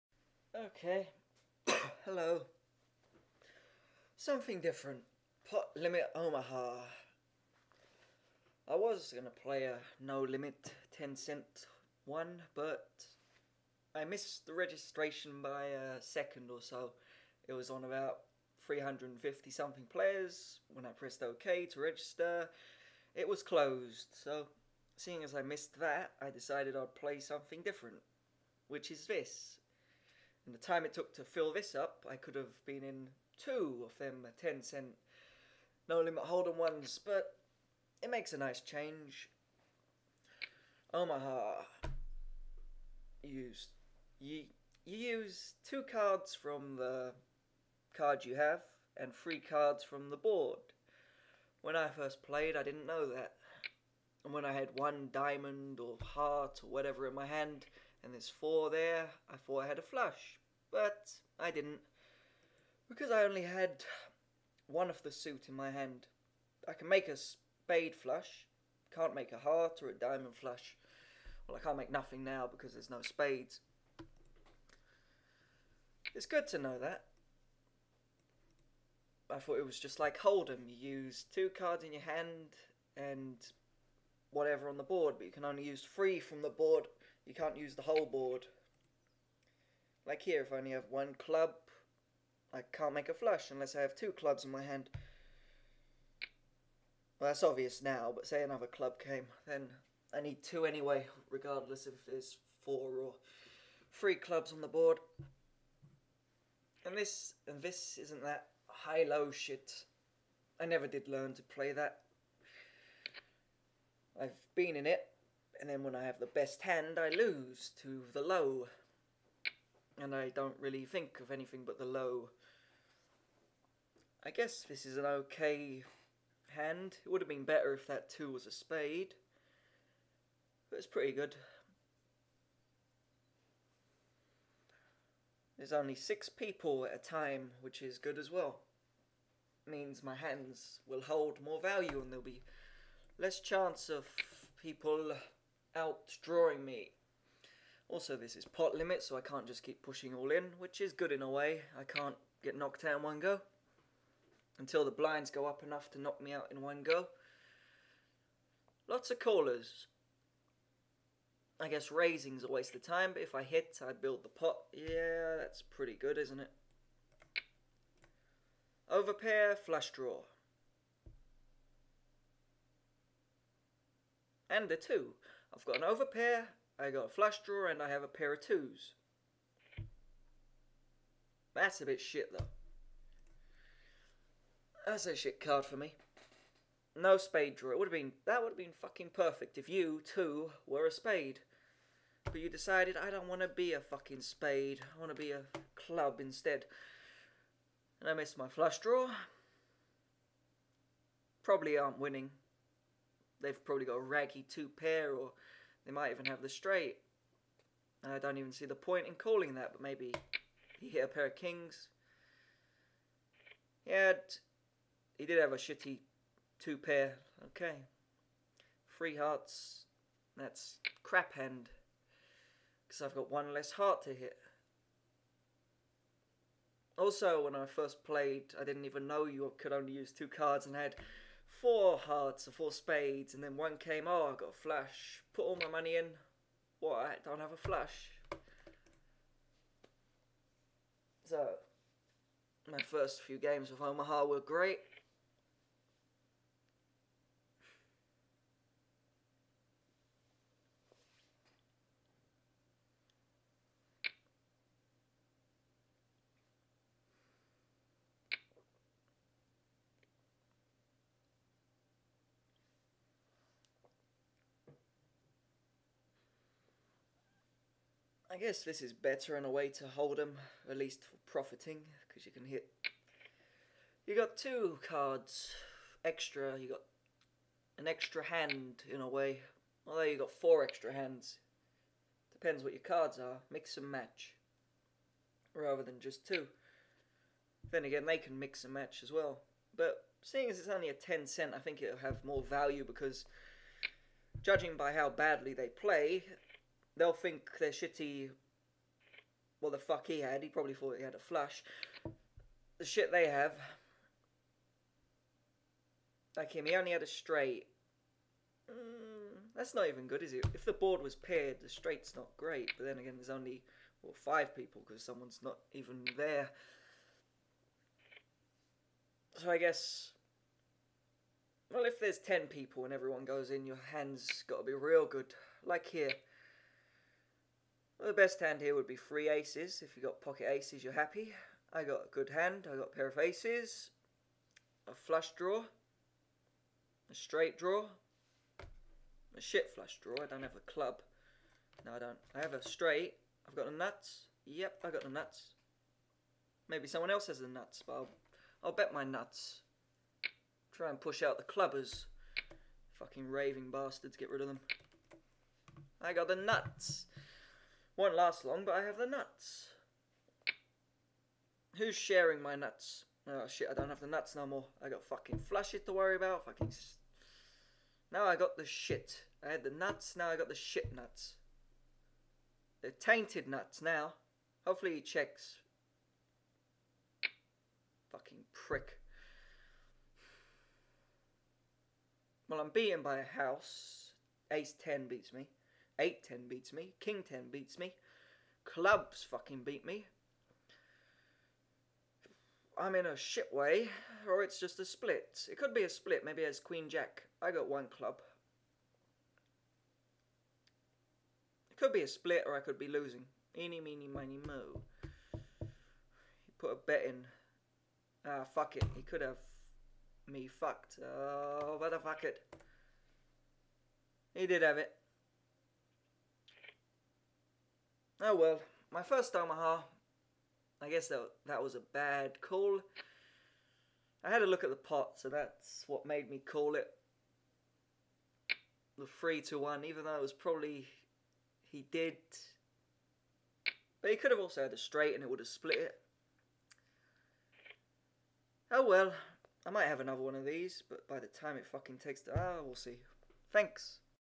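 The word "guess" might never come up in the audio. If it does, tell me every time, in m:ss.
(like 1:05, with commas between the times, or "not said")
2:04, 2:41, 4:28, 5:19, 7:00.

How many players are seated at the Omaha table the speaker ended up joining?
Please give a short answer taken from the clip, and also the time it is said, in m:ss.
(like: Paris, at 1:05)
6, at 2:15.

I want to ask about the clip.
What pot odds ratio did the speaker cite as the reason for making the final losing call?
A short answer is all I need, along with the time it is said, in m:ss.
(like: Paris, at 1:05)
3 to 1, at 7:09.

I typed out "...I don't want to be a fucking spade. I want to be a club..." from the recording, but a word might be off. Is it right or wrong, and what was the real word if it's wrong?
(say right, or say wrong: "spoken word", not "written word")
right.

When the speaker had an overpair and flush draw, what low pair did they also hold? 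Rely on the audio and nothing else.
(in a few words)
twos.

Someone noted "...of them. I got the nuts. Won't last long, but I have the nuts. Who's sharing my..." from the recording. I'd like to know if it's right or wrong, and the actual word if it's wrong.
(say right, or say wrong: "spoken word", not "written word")
right.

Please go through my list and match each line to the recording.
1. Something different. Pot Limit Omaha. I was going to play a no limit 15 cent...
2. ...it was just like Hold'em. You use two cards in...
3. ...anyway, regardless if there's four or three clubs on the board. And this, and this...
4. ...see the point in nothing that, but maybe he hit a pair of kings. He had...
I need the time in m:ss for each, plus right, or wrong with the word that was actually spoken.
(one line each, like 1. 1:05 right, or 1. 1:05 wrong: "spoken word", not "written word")
1. 0:04 wrong: "10", not "15"
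2. 1:19 right
3. 1:40 right
4. 3:28 wrong: "calling", not "nothing".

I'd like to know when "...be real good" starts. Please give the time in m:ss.
5:24.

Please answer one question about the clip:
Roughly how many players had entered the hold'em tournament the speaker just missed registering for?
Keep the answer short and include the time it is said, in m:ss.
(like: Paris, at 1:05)
about 350, at 0:17.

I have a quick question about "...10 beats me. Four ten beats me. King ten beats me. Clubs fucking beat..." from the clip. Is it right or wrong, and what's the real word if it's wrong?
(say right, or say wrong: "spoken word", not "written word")
wrong: "Eight", not "Four".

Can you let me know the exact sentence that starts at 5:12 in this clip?
But then again, there's only well, five people because someone's not even there.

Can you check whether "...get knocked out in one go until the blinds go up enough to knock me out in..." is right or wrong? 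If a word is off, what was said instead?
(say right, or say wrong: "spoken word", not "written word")
right.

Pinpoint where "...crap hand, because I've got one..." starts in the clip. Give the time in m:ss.
3:41.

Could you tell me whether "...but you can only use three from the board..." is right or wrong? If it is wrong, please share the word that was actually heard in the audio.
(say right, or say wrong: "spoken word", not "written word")
right.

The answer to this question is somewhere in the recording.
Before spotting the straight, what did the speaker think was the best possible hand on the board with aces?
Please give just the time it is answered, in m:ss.
5:28.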